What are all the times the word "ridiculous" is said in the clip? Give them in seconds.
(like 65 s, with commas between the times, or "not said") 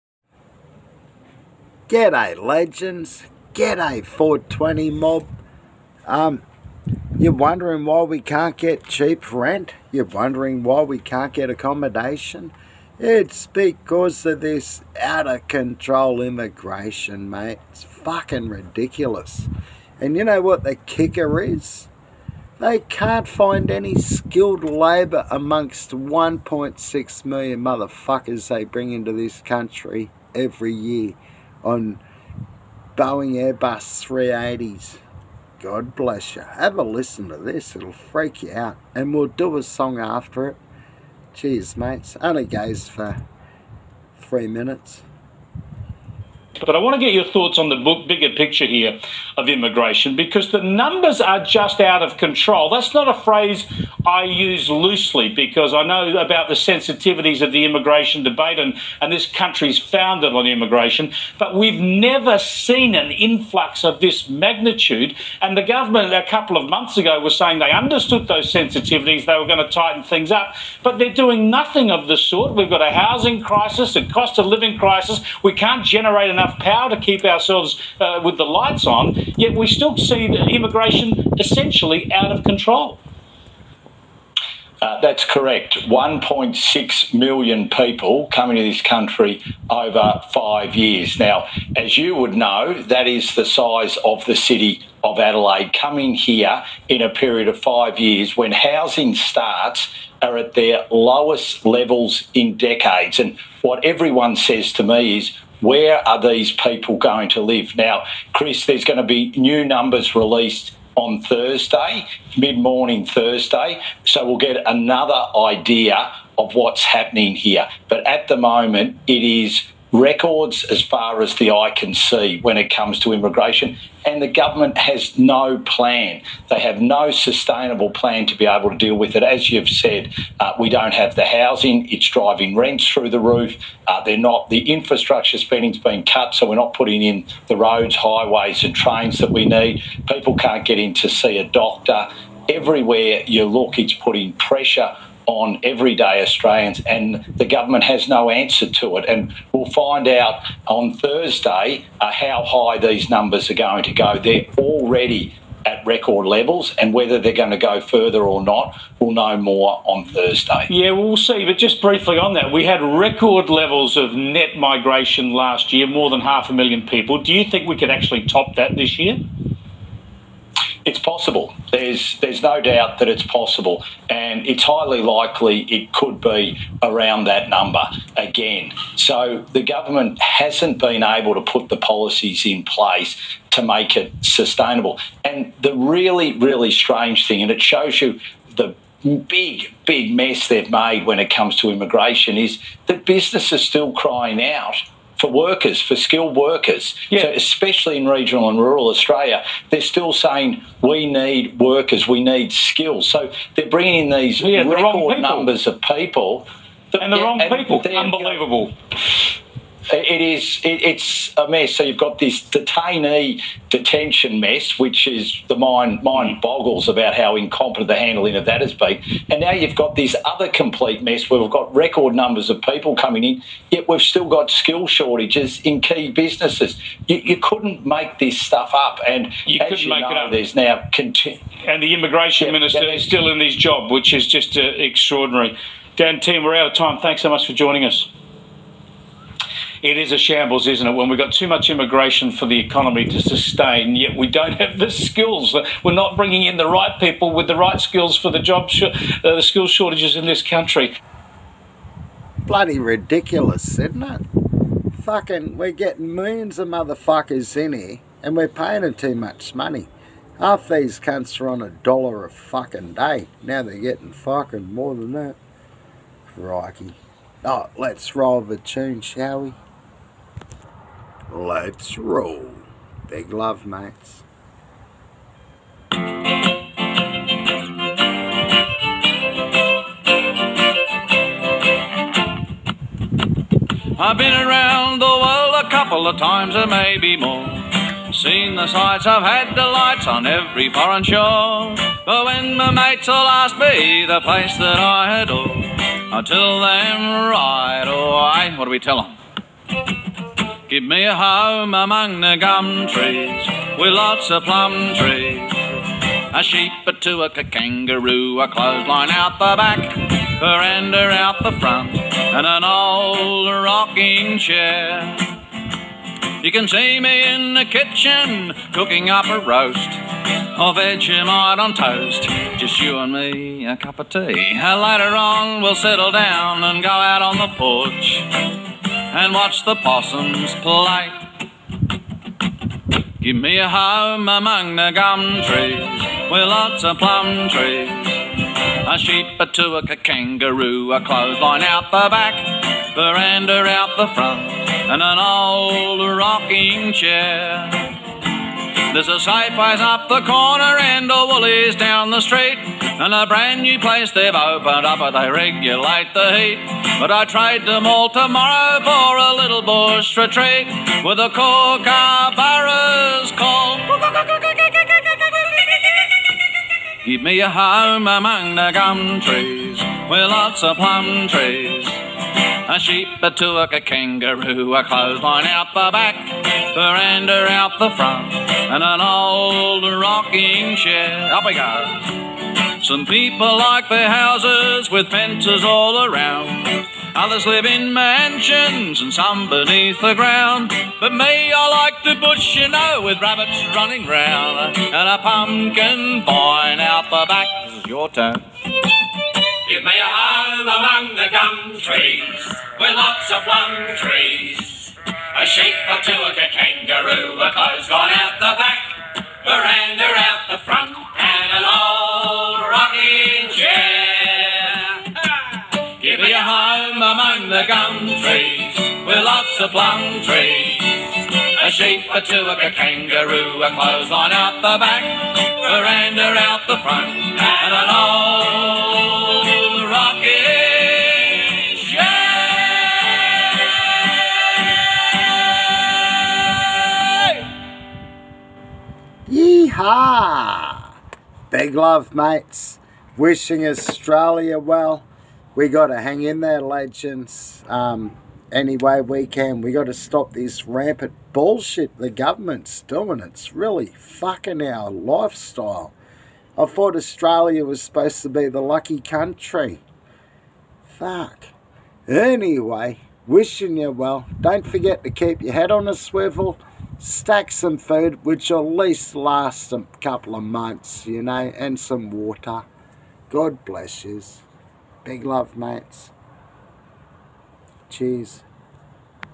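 18 s, 252 s.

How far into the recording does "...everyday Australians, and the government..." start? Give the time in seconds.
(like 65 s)
145 s.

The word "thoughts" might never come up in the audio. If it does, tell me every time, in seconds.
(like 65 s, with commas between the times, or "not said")
47 s, 456 s.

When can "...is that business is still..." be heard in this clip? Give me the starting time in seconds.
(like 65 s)
192 s.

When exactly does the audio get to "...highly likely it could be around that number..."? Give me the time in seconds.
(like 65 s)
174 s.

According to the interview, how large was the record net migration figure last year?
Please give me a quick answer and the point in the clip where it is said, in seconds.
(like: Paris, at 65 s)
more than half a million, at 165 s.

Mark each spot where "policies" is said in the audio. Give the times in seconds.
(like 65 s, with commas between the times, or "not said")
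181 s.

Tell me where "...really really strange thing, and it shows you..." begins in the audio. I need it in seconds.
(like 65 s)
185 s.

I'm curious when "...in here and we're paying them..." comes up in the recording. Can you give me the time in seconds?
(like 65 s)
257 s.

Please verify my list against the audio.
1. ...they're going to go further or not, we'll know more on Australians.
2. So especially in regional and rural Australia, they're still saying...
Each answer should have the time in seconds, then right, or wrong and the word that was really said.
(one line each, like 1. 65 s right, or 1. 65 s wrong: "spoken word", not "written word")
1. 157 s wrong: "Thursday", not "Australians"
2. 197 s right.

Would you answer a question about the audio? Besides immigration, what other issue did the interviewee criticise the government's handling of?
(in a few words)
detention.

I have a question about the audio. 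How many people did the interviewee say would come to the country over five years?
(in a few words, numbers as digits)
1.6 million.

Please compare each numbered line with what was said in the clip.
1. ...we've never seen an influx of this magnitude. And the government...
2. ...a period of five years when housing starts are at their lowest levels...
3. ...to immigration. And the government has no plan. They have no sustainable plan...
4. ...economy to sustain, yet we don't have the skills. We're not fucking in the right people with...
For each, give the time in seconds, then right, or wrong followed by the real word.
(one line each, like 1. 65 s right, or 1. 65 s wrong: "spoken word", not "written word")
1. 61 s right
2. 97 s right
3. 122 s right
4. 242 s wrong: "bringing", not "fucking".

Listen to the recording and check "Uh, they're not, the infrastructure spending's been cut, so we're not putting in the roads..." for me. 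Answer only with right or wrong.
right.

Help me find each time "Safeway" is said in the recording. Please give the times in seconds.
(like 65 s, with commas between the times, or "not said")
349 s.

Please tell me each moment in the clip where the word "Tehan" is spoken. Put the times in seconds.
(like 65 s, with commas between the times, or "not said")
236 s.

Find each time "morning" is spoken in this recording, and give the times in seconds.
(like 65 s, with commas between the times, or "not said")
112 s.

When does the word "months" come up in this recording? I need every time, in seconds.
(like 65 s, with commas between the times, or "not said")
66 s, 470 s.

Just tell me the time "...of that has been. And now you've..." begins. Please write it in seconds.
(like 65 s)
218 s.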